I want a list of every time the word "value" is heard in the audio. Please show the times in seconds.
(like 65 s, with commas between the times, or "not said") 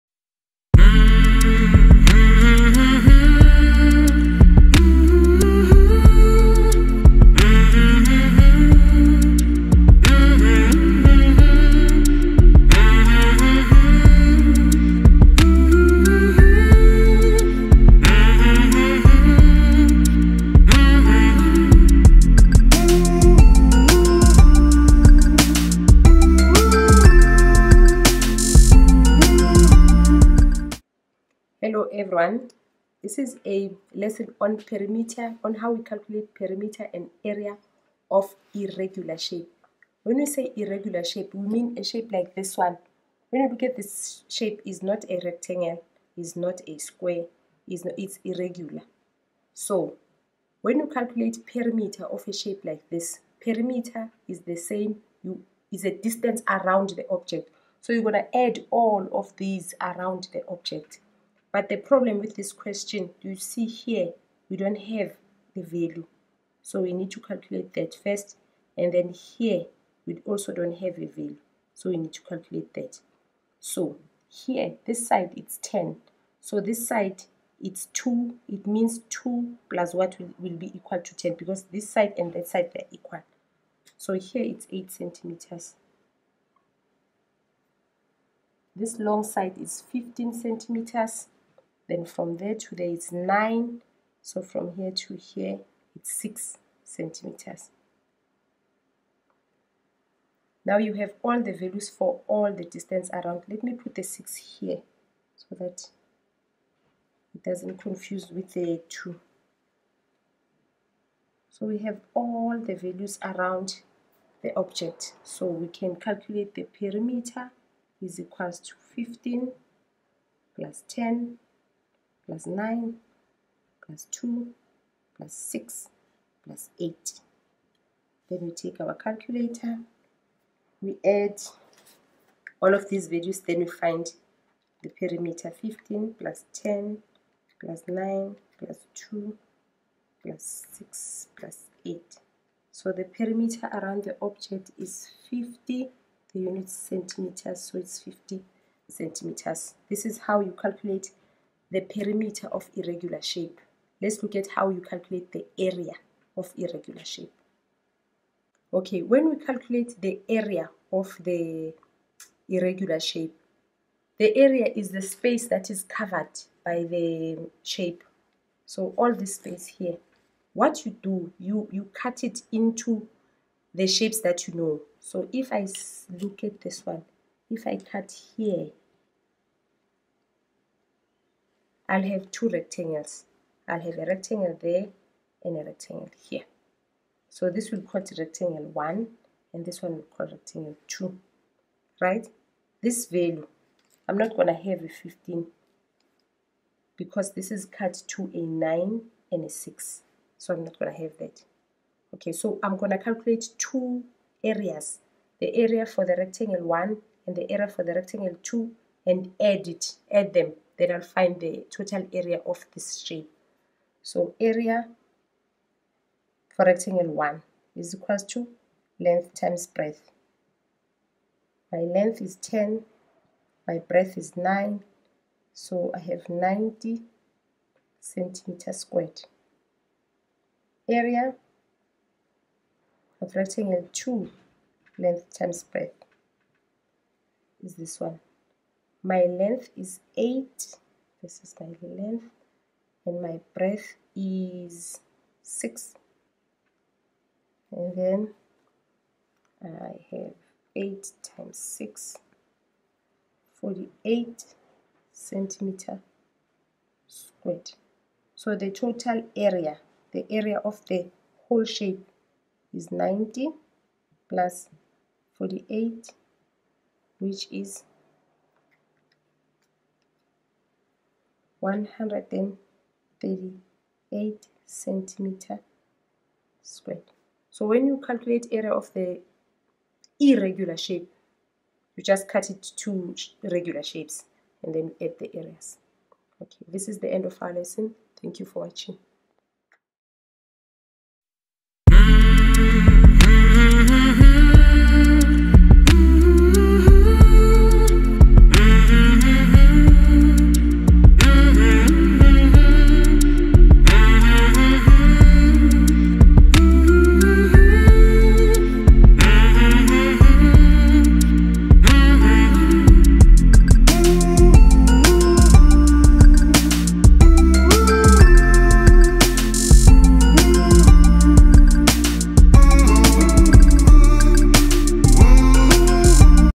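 65 s, 71 s, 101 s, 112 s, 133 s, 193 s.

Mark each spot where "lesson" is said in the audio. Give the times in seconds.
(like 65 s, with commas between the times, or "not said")
33 s, 287 s.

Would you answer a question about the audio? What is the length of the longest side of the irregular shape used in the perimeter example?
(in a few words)
15 centimeters.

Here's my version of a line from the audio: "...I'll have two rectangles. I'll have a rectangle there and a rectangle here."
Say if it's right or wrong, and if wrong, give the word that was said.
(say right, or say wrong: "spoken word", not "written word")
right.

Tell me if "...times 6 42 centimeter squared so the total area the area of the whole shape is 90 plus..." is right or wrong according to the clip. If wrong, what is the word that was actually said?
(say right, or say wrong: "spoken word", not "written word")
wrong: "48", not "42".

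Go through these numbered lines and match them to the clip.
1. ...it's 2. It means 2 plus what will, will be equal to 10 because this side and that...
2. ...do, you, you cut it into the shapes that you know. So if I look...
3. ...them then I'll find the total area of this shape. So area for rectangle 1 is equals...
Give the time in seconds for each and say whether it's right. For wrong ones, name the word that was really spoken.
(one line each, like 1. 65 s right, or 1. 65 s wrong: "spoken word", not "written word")
1. 77 s right
2. 171 s right
3. 210 s right.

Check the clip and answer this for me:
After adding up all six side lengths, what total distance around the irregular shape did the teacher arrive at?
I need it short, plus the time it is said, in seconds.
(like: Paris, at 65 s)
50 centimeters, at 147 s.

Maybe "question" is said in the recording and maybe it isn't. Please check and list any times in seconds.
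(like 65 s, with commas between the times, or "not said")
62 s.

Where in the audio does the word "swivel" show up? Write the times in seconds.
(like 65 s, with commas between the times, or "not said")
not said.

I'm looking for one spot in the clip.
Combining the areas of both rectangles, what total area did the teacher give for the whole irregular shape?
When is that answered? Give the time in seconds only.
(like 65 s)
271 s.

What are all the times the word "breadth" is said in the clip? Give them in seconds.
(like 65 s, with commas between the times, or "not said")
219 s, 223 s, 235 s, 243 s.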